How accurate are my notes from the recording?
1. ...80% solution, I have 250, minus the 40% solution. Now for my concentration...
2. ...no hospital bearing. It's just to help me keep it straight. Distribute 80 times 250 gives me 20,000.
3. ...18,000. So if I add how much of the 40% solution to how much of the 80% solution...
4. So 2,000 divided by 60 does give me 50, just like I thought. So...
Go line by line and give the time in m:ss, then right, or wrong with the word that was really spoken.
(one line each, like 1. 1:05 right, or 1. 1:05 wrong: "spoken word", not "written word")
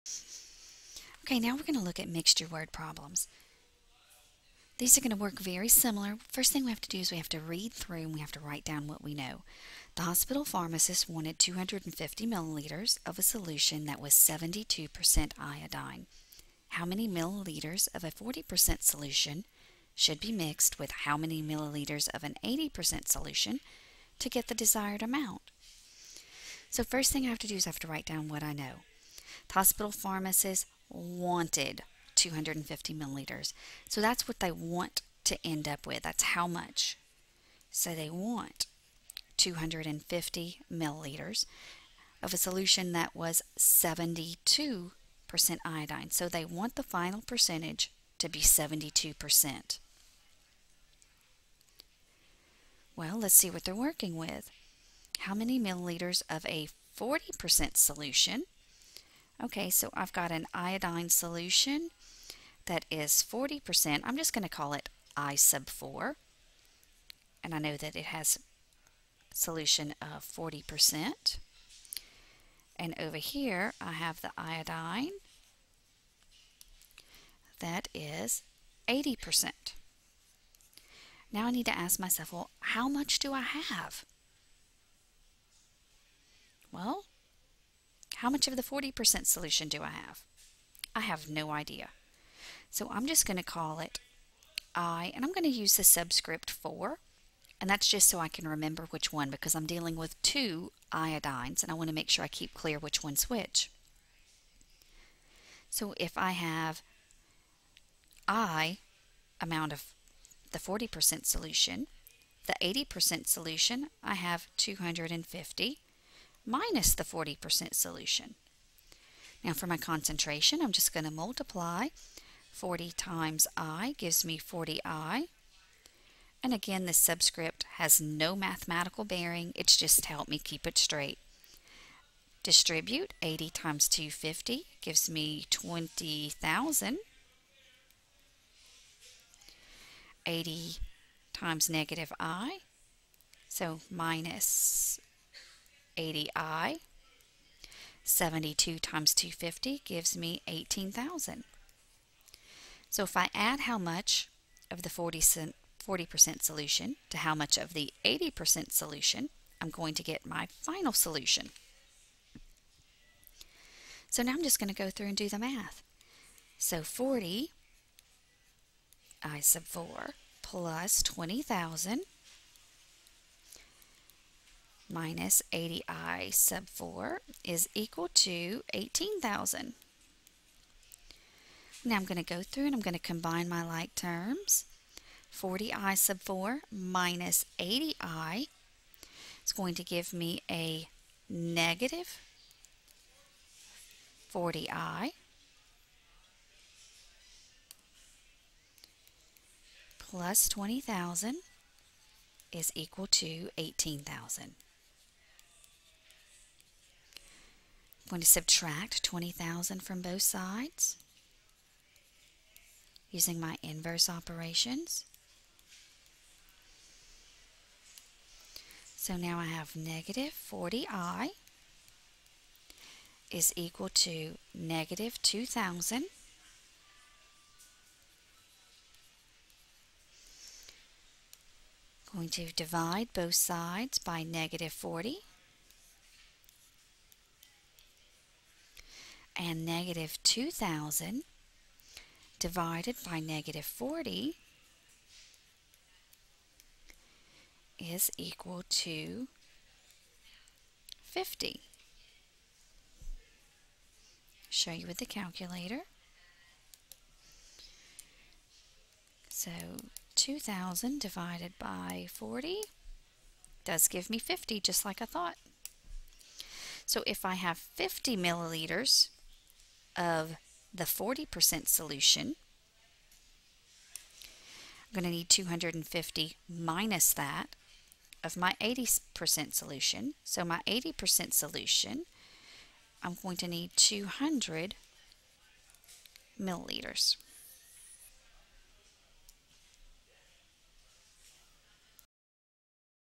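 1. 1:52 right
2. 2:08 wrong: "mathematical", not "hospital"
3. 2:30 right
4. 4:19 wrong: "40", not "60".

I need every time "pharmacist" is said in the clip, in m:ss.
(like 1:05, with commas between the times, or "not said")
0:10, 0:29.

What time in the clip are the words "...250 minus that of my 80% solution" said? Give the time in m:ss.
4:35.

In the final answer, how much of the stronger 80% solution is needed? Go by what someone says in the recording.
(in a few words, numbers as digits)
200 milliliters.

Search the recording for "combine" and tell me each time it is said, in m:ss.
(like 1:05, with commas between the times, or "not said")
3:02.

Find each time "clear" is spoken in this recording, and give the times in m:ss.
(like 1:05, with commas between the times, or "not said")
1:42.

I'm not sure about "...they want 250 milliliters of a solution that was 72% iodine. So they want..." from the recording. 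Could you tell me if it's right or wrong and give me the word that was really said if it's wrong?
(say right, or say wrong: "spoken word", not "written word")
right.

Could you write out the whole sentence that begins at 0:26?
So first thing I have to do is I have to write down what I know.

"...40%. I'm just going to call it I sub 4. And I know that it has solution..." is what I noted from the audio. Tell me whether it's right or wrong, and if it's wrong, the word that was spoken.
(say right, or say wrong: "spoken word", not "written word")
right.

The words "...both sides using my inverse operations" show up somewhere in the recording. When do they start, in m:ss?
3:30.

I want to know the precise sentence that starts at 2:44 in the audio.
So now I'm just going to go through and do the math.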